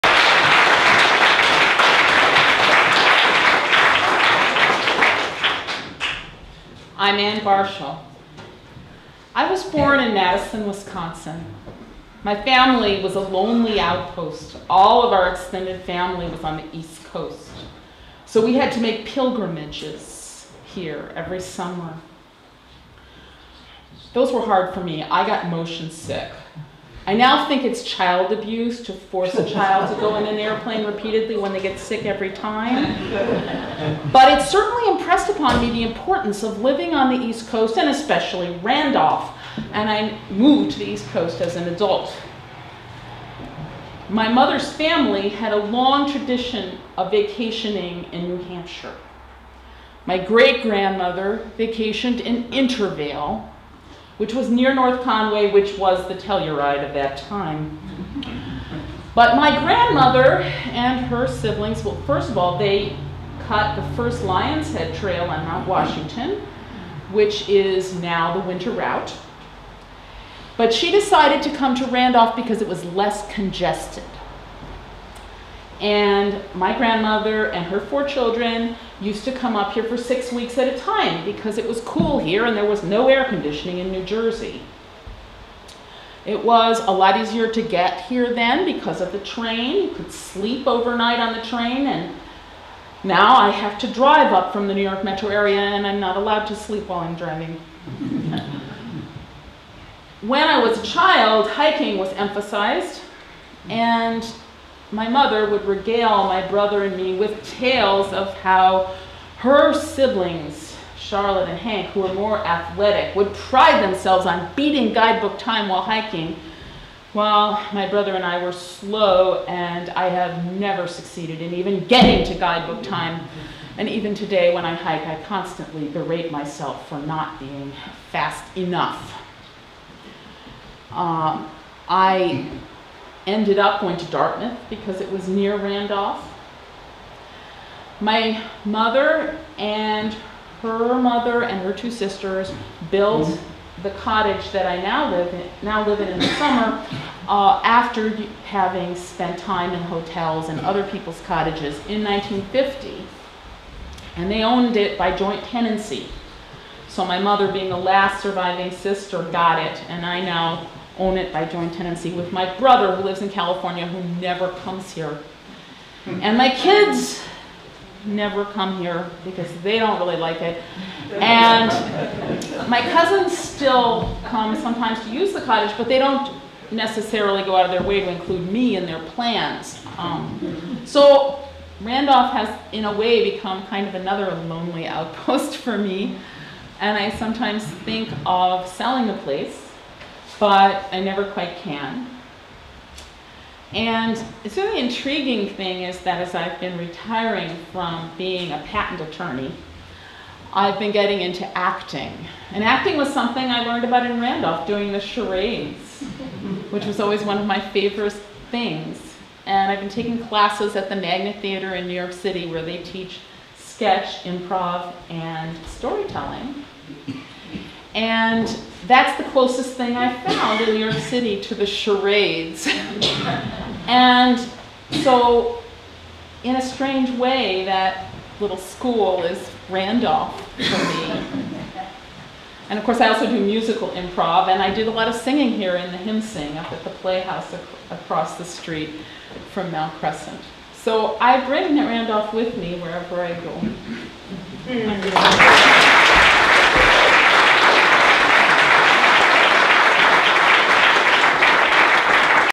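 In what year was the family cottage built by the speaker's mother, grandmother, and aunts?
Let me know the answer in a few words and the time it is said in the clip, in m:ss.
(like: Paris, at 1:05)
1950, at 2:32.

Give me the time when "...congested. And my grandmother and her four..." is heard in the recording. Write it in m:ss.
1:13.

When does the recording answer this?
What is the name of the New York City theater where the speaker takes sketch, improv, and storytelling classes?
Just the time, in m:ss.
3:30.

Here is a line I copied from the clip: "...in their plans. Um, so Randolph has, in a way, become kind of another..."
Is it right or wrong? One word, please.
right.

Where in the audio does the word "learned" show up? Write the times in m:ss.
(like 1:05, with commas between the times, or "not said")
3:23.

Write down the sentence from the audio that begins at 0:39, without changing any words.
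And I moved to the East Coast as an adult.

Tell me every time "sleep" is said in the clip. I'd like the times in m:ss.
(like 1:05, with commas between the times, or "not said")
1:30, 1:36.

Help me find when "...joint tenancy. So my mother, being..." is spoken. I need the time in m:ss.
2:35.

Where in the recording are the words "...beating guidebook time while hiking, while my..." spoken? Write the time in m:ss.
1:54.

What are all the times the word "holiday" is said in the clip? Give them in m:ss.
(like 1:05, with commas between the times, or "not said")
not said.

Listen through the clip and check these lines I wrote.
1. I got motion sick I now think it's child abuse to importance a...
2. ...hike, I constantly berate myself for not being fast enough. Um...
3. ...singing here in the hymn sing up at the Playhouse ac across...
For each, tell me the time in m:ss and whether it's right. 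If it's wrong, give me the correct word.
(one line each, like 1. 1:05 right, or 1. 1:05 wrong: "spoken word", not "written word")
1. 0:25 wrong: "force", not "importance"
2. 2:04 right
3. 3:55 right.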